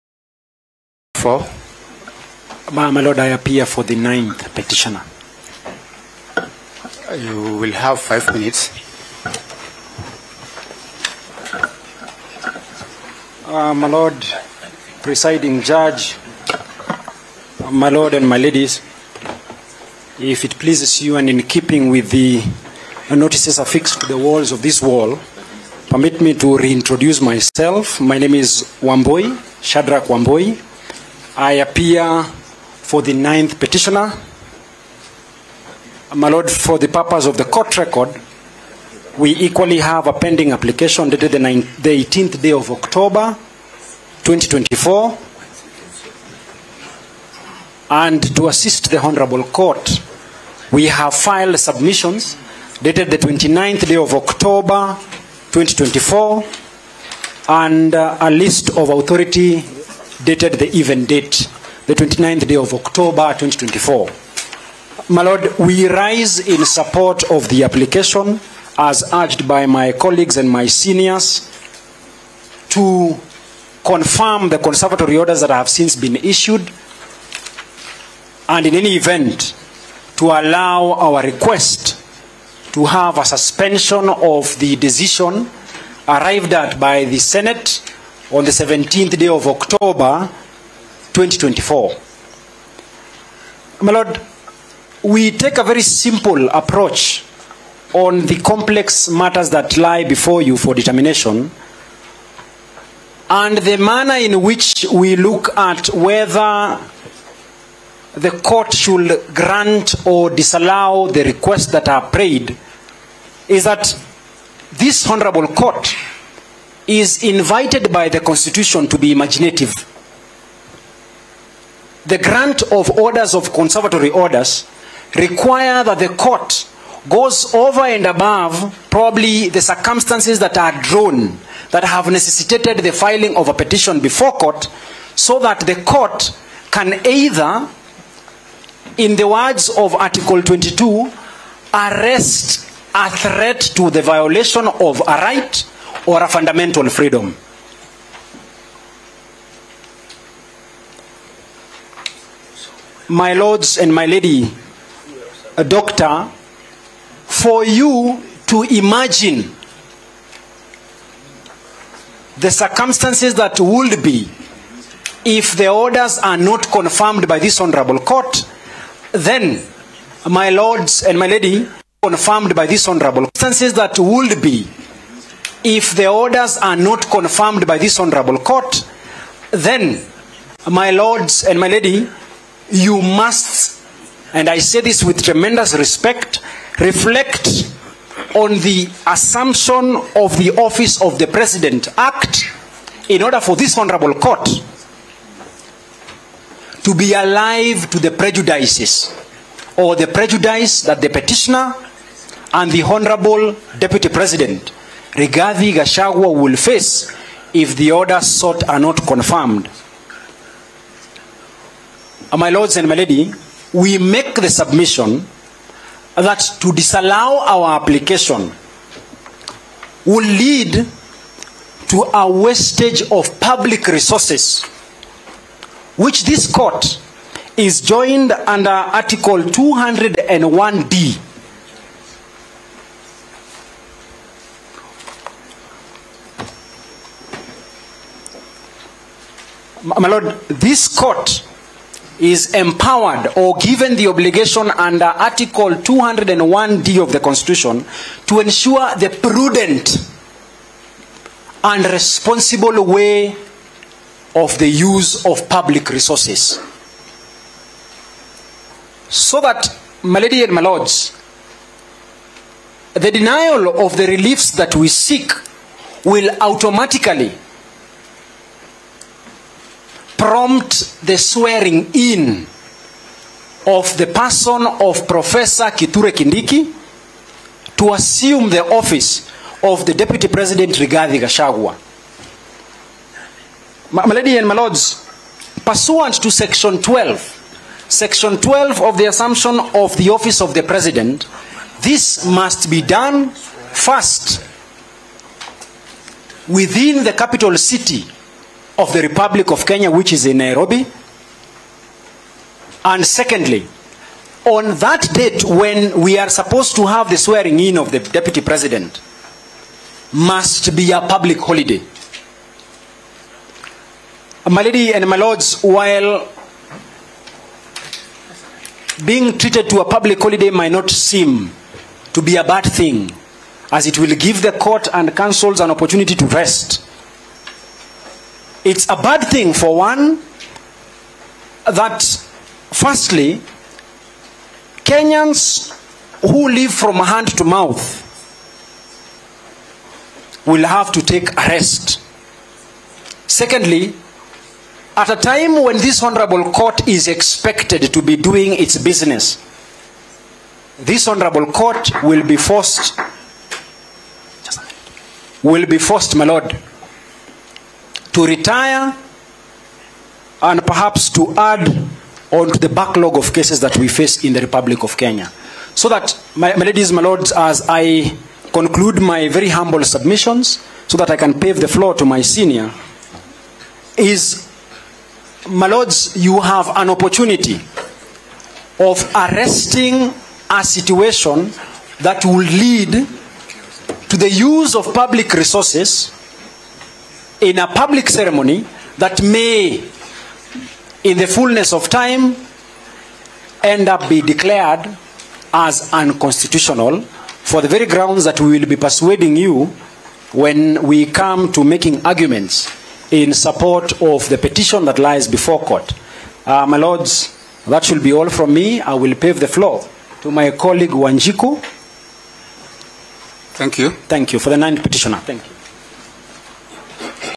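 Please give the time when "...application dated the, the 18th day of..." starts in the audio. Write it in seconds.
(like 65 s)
40 s.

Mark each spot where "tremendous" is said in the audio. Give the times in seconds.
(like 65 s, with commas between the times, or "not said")
185 s.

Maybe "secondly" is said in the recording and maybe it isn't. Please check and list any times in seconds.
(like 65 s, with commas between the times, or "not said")
303 s, 343 s.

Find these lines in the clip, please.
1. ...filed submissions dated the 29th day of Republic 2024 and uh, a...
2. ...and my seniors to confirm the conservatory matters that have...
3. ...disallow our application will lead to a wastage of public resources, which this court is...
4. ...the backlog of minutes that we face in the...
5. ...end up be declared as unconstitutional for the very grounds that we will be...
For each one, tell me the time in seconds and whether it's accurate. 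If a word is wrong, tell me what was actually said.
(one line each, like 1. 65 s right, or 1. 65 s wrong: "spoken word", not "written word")
1. 51 s wrong: "October", not "Republic"
2. 70 s wrong: "orders", not "matters"
3. 216 s right
4. 362 s wrong: "cases", not "minutes"
5. 393 s right.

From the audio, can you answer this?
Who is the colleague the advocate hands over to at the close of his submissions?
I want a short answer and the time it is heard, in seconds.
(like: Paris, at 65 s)
Wanjiku, at 410 s.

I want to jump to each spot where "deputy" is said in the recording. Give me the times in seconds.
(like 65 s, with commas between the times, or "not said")
203 s, 279 s, 307 s.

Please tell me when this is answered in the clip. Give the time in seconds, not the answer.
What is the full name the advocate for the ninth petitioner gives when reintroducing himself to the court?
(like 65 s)
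29 s.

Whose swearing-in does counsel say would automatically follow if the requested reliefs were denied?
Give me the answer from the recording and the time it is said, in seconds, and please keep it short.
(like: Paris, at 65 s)
Professor Kiture Kindiki, at 275 s.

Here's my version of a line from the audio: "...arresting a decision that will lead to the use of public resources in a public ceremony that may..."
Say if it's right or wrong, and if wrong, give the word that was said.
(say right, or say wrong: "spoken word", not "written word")
wrong: "situation", not "decision".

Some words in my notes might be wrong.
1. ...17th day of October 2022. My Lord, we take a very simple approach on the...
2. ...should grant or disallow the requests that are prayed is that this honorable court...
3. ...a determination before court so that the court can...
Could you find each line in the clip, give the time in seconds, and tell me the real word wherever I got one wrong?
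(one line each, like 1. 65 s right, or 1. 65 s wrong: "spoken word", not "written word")
1. 88 s wrong: "2024", not "2022"
2. 108 s right
3. 133 s wrong: "petition", not "determination".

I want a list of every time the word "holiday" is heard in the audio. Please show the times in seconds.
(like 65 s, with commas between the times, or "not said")
311 s, 320 s.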